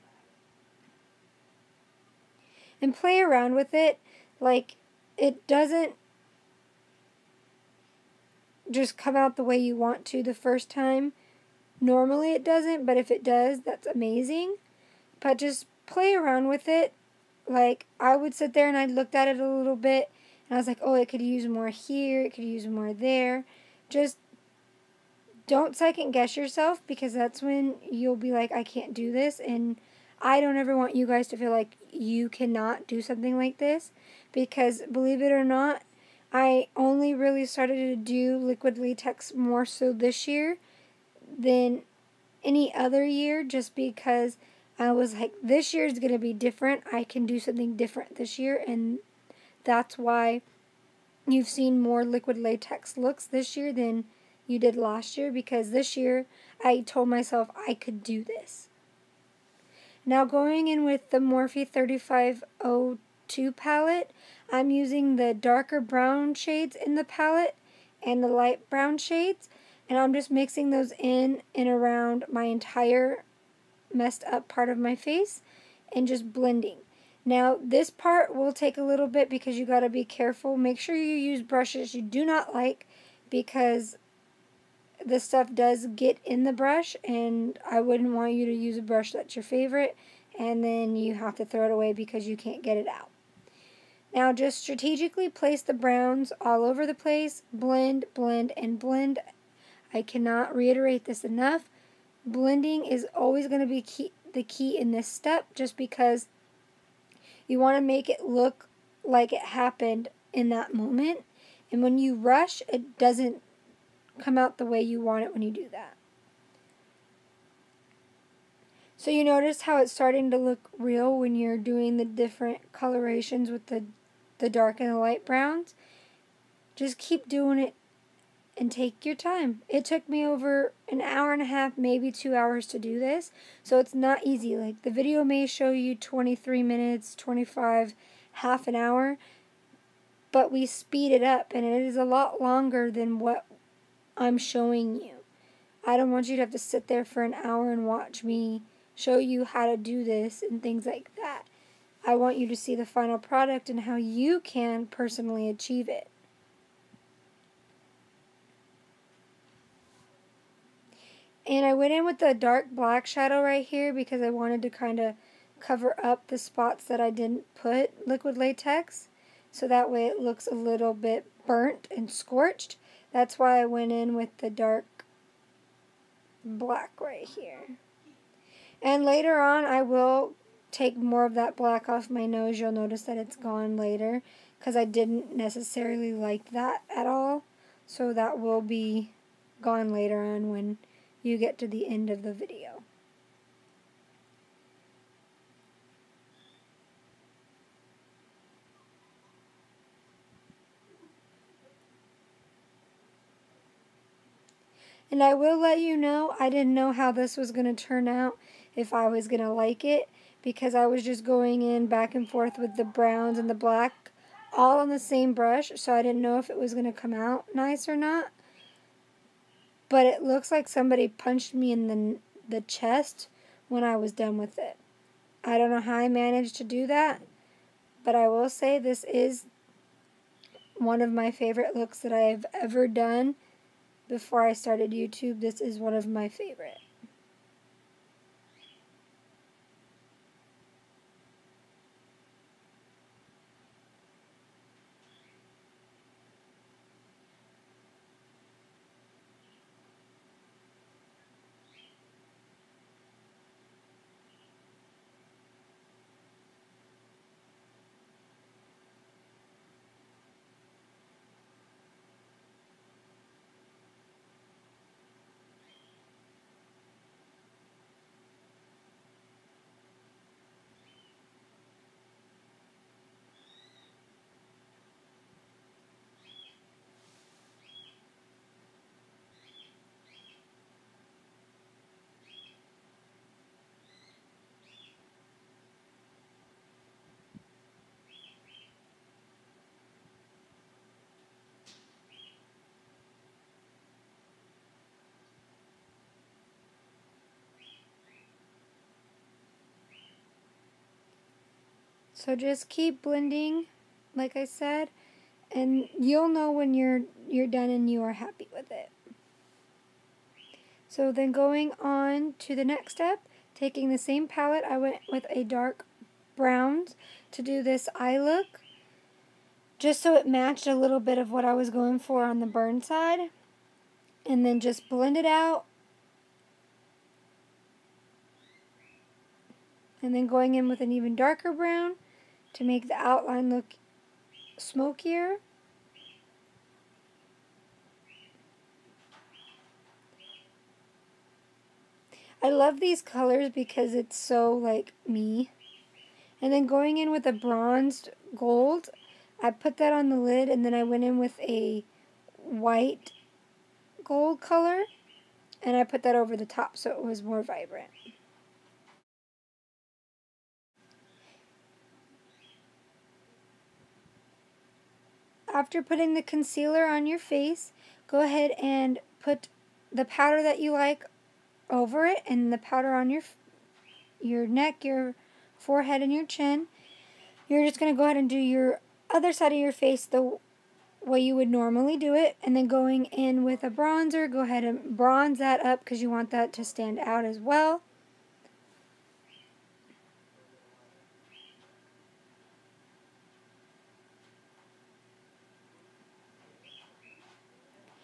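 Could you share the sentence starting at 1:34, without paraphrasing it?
Now just strategically place the browns all over the place.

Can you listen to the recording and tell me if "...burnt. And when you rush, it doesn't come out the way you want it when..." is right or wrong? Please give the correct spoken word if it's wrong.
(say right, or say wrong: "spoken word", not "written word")
wrong: "moment", not "burnt".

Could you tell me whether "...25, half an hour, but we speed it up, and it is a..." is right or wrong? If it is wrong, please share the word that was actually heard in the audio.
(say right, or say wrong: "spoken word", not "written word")
right.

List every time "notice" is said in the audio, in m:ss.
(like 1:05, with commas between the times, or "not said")
1:59, 3:02.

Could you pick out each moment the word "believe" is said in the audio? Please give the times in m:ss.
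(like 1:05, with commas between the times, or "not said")
0:34.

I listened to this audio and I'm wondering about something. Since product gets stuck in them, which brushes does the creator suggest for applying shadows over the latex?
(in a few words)
brushes you do not like.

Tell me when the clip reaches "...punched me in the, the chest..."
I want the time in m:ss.
3:41.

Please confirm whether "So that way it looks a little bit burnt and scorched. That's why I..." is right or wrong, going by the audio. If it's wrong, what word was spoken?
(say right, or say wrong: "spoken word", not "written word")
right.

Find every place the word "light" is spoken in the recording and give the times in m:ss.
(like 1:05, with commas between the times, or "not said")
1:08, 2:04.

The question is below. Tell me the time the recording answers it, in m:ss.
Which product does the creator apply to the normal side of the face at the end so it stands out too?
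6:23.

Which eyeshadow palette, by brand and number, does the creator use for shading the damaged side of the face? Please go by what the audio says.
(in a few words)
Morphe 3502.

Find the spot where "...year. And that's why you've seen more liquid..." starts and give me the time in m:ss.
0:48.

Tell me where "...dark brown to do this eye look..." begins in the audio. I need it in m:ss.
5:15.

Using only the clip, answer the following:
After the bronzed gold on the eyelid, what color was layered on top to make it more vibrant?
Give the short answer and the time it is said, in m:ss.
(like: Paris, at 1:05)
white gold, at 5:52.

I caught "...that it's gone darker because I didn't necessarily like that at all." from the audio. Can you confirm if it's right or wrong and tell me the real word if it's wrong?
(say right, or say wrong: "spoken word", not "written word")
wrong: "later", not "darker".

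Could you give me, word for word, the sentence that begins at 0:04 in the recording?
Like, it doesn't just come out the way you want to the first time.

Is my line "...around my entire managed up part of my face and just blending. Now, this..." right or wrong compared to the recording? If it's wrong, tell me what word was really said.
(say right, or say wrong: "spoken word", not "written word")
wrong: "messed", not "managed".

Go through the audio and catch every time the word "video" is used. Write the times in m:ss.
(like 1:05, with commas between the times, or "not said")
2:14, 3:12.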